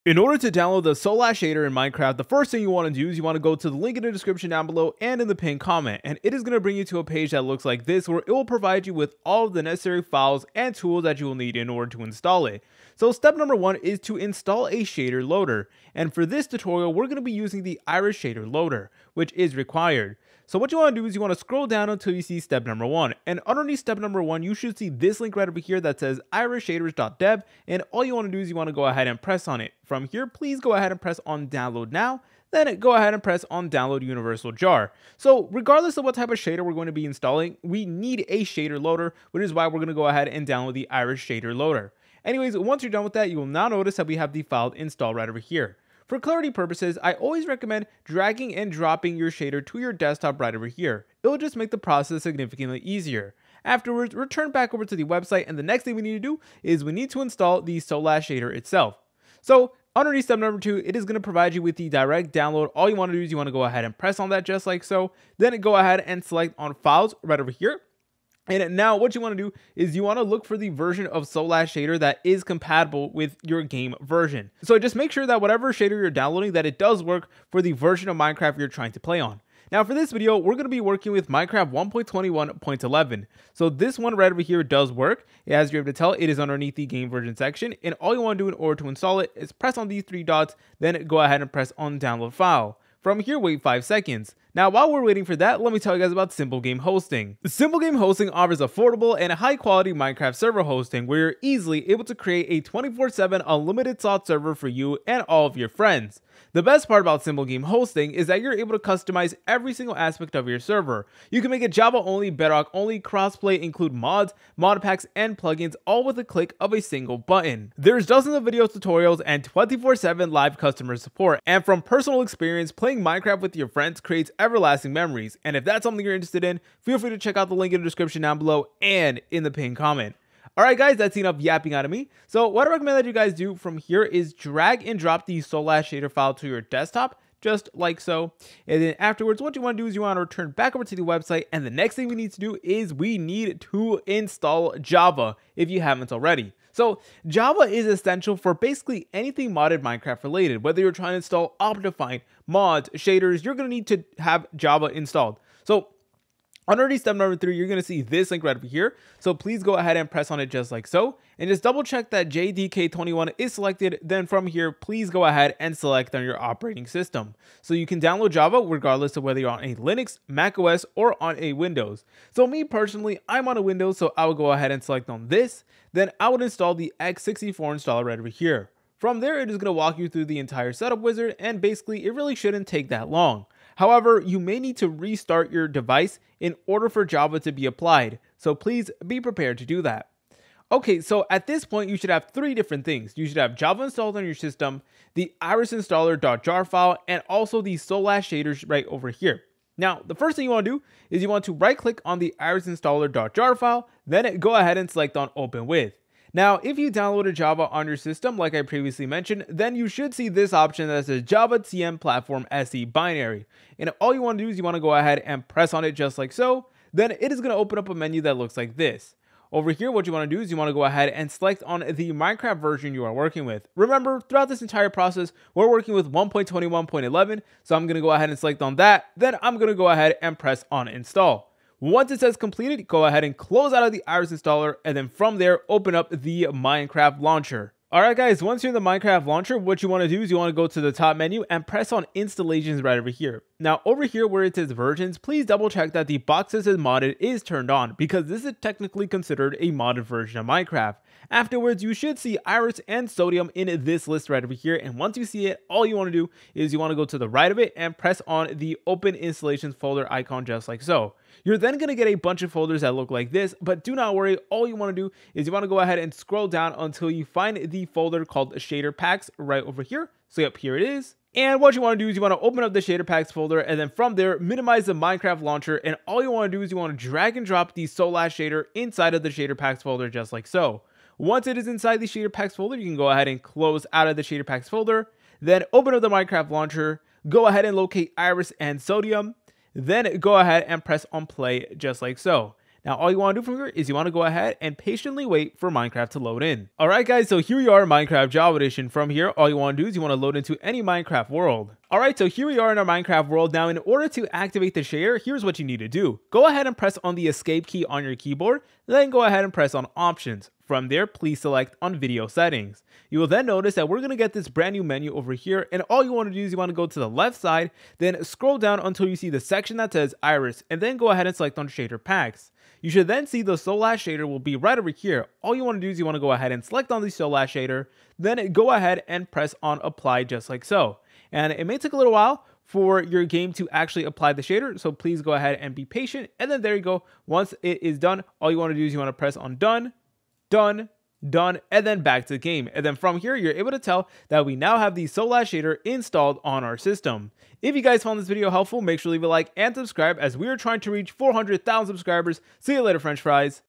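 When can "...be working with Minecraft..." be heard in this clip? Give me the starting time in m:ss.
1:20.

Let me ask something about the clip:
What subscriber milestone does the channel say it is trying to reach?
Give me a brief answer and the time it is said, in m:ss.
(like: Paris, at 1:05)
400,000, at 5:51.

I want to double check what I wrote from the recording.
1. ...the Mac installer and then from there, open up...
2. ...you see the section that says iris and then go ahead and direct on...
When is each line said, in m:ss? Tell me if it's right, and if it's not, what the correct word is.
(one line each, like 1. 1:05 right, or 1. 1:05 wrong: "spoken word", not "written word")
1. 3:53 wrong: "Iris", not "Mac"
2. 5:19 wrong: "select", not "direct".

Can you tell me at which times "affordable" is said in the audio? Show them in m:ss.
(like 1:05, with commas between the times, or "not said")
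1:38.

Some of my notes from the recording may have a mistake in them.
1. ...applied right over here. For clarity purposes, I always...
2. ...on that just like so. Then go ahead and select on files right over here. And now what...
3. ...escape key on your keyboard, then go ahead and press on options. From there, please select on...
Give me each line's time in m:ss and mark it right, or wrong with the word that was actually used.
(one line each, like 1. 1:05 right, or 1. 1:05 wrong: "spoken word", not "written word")
1. 0:44 wrong: "installed", not "applied"
2. 1:04 right
3. 5:07 right.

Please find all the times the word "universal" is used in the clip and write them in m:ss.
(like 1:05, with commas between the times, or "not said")
0:34.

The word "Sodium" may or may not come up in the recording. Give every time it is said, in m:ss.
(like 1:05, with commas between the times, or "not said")
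4:13, 4:48.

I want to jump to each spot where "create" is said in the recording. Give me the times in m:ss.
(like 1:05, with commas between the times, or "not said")
1:42, 2:04.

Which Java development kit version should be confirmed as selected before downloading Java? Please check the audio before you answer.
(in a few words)
JDK21.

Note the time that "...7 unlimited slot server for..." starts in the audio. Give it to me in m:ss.
1:43.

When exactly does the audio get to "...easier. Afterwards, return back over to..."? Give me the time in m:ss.
0:52.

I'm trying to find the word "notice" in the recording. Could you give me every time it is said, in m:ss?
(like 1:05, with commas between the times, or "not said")
0:43, 5:13.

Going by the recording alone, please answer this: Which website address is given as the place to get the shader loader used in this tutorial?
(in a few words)
irisshaders.dev.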